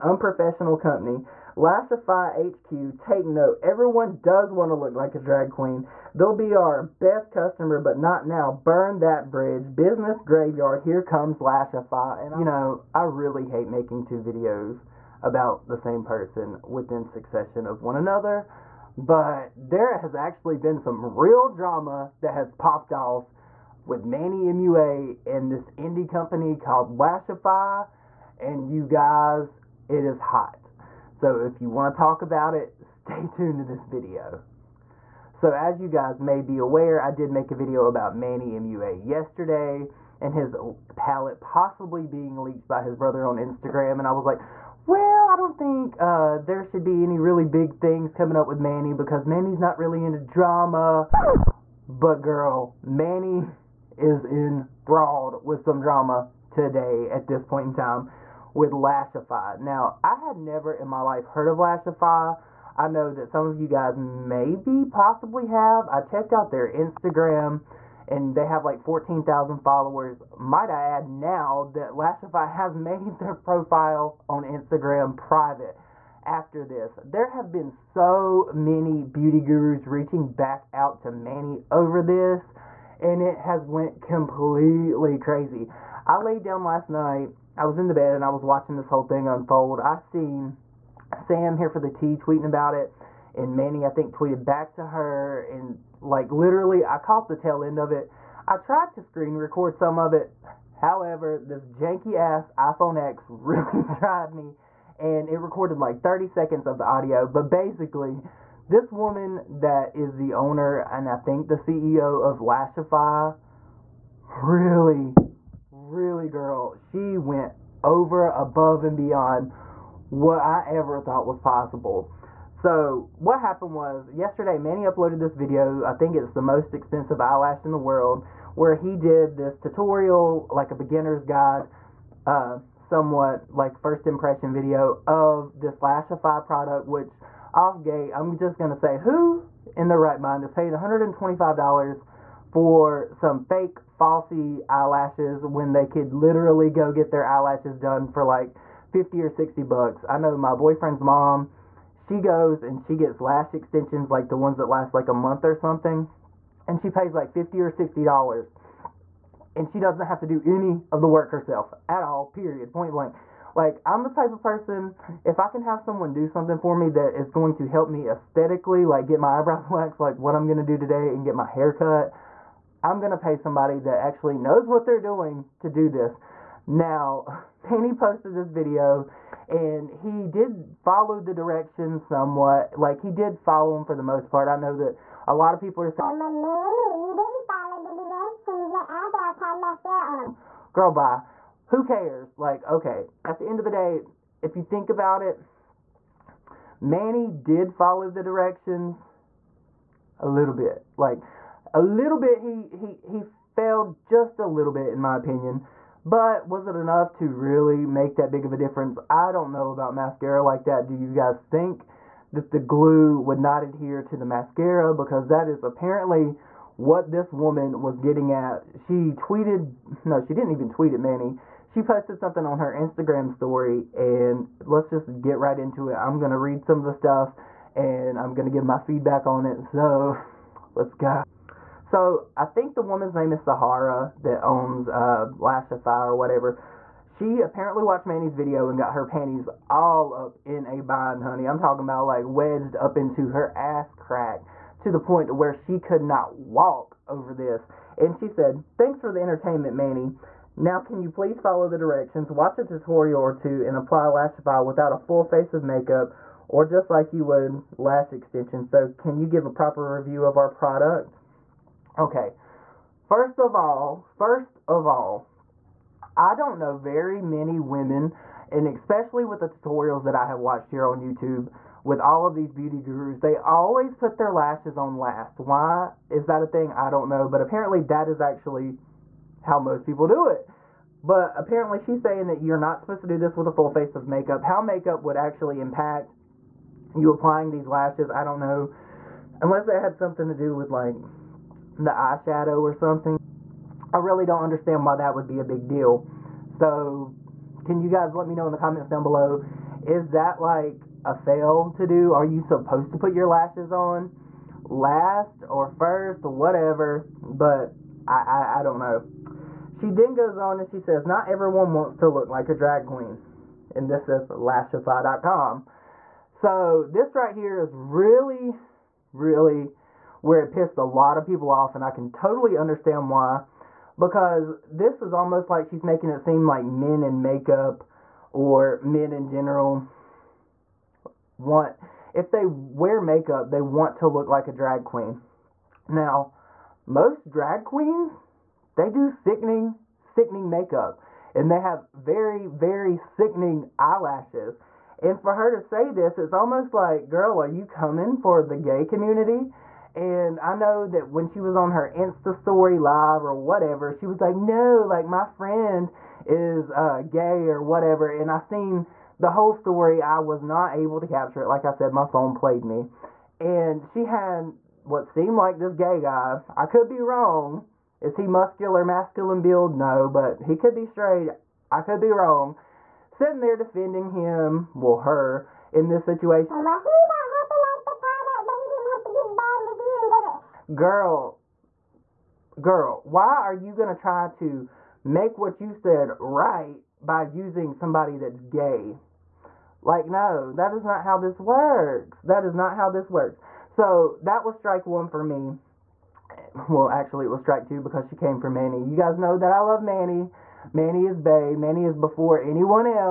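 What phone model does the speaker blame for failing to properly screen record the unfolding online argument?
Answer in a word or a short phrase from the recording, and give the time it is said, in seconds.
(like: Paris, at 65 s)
iPhone X, at 102 s.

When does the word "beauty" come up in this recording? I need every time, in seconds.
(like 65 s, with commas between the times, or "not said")
79 s, 272 s.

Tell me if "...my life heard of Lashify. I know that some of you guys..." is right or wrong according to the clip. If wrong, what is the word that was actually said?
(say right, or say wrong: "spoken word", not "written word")
right.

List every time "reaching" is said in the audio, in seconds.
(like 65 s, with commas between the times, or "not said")
79 s.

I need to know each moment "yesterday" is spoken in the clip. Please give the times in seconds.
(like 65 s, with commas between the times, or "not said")
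39 s, 124 s.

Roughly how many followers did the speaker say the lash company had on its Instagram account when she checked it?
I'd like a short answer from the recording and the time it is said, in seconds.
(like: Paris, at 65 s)
14,000, at 68 s.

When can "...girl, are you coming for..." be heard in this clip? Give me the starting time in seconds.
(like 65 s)
347 s.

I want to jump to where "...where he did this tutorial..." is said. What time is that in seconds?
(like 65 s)
128 s.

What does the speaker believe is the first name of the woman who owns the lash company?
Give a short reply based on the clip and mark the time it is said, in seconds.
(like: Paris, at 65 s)
Sahara, at 233 s.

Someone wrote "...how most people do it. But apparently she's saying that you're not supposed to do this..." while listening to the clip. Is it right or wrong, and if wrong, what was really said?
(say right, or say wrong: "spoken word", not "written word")
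right.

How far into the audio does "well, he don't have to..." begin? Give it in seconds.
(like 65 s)
376 s.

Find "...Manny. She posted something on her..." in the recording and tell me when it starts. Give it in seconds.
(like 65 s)
221 s.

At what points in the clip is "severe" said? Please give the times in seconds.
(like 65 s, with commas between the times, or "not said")
not said.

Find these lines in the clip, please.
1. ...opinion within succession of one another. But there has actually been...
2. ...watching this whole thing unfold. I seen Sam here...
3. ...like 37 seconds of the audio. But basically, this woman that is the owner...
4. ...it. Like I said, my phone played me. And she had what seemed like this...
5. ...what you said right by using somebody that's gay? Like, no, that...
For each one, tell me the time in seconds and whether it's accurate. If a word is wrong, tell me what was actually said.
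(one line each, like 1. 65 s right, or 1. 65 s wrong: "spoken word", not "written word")
1. 16 s wrong: "person", not "opinion"
2. 88 s right
3. 105 s wrong: "30", not "37"
4. 361 s right
5. 385 s right.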